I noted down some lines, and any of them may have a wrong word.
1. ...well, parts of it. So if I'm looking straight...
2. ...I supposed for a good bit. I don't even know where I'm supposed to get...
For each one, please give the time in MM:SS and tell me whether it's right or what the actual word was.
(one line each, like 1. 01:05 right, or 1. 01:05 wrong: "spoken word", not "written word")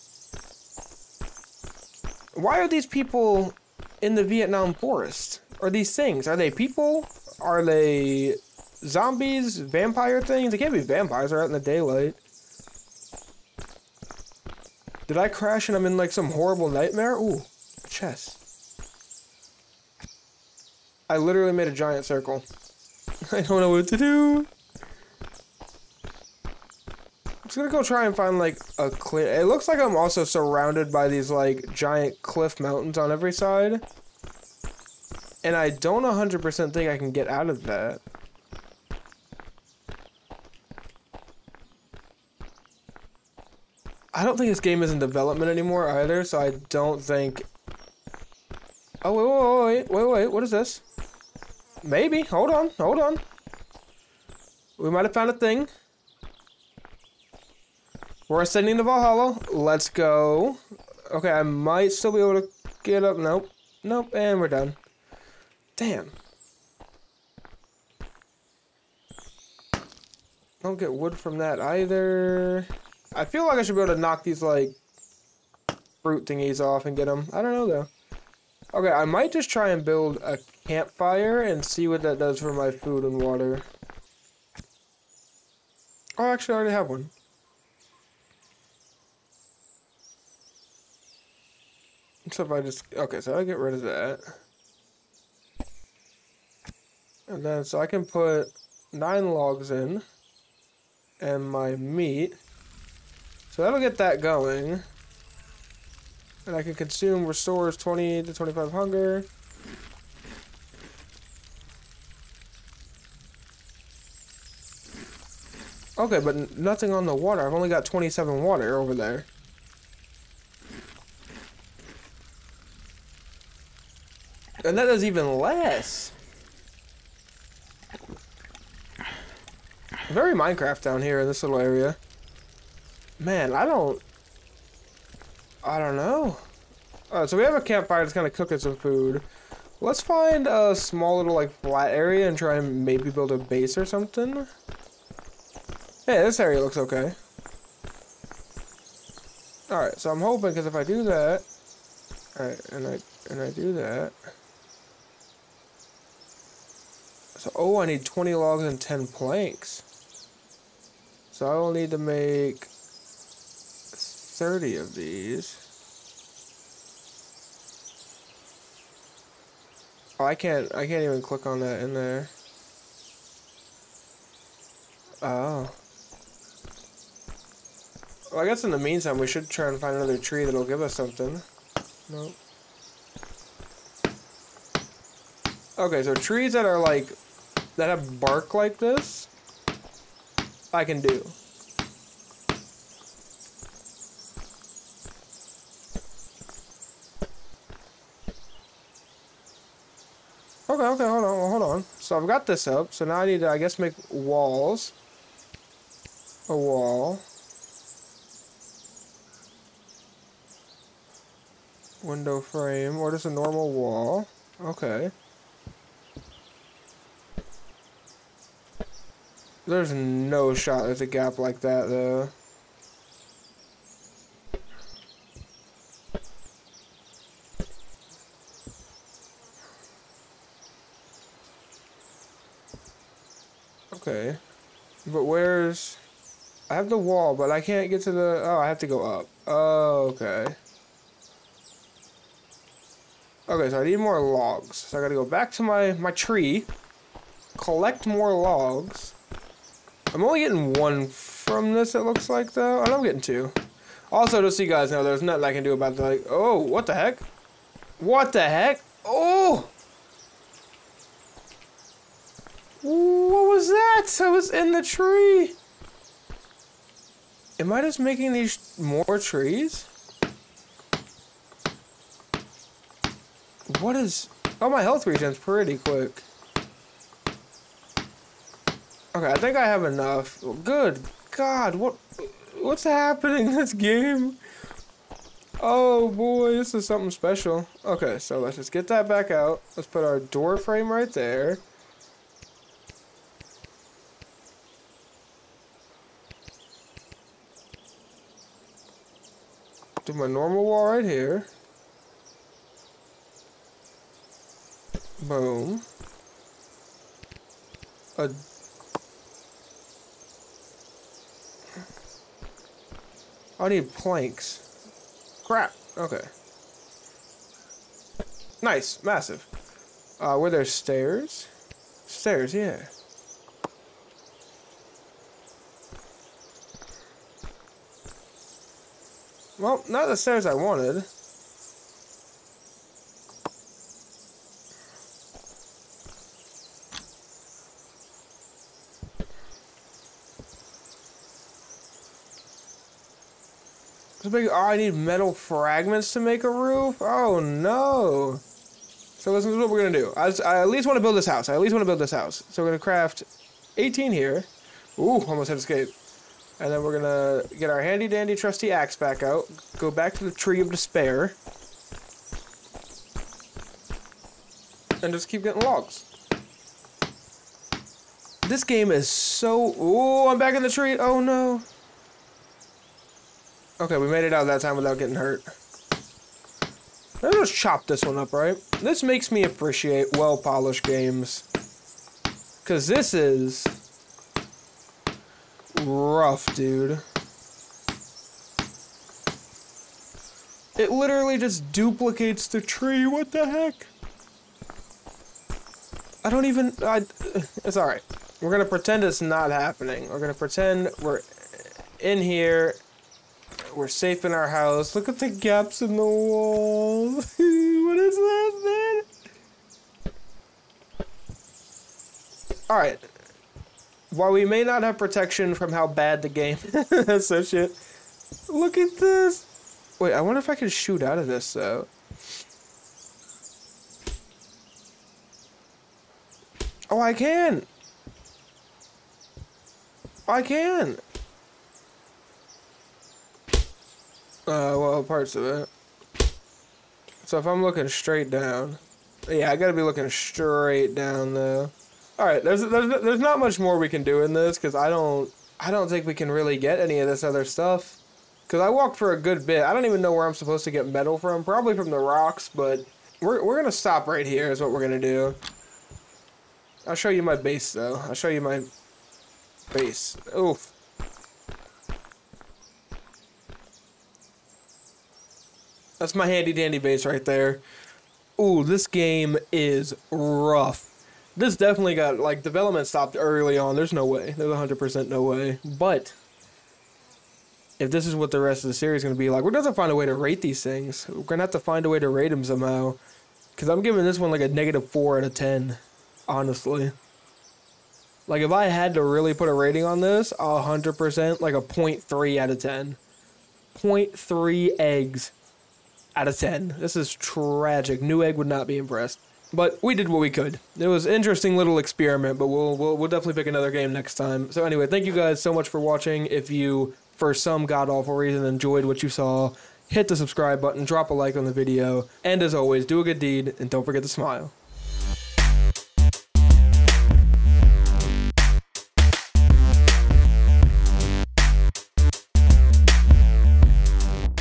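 1. 07:14 right
2. 07:28 wrong: "walked", not "supposed".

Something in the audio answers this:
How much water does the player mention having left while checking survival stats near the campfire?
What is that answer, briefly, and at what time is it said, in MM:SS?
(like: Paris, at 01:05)
27, at 01:57.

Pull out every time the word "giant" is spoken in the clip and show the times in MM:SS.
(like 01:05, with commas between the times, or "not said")
00:21, 00:31.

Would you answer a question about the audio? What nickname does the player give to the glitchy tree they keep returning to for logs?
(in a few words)
Tree of Despair.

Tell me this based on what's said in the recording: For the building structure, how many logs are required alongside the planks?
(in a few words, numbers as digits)
20.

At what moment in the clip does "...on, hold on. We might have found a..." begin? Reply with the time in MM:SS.
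00:52.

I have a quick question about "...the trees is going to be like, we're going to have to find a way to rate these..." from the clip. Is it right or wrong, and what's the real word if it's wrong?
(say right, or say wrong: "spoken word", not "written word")
wrong: "series", not "trees".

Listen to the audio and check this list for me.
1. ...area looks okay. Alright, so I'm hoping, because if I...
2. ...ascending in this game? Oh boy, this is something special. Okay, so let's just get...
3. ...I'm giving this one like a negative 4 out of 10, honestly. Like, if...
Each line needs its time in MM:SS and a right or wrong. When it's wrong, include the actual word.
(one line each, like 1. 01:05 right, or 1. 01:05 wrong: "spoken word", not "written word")
1. 02:26 right
2. 04:42 wrong: "happening", not "ascending"
3. 08:03 right.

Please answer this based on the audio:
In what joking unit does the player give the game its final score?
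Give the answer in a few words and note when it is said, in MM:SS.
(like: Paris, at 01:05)
Eggs, at 08:14.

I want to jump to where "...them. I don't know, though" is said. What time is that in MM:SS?
01:17.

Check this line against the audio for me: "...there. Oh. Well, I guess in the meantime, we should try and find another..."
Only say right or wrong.
right.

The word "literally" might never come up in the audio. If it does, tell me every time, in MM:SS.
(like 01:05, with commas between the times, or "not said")
00:21, 06:30.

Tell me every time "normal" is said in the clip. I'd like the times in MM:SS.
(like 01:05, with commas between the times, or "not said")
03:33, 05:00.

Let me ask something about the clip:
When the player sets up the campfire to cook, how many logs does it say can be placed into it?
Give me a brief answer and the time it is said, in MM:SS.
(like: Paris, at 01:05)
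9, at 01:38.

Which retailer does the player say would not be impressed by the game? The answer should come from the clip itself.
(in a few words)
Newegg.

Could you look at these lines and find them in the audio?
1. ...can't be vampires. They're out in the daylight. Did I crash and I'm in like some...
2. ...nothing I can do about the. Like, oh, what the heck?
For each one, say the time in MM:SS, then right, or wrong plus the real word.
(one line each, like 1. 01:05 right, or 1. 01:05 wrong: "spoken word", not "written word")
1. 00:10 right
2. 04:15 right.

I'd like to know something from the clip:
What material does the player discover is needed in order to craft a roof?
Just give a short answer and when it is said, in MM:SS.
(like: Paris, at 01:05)
Metal fragments, at 05:44.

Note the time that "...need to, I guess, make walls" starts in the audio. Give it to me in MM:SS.
03:23.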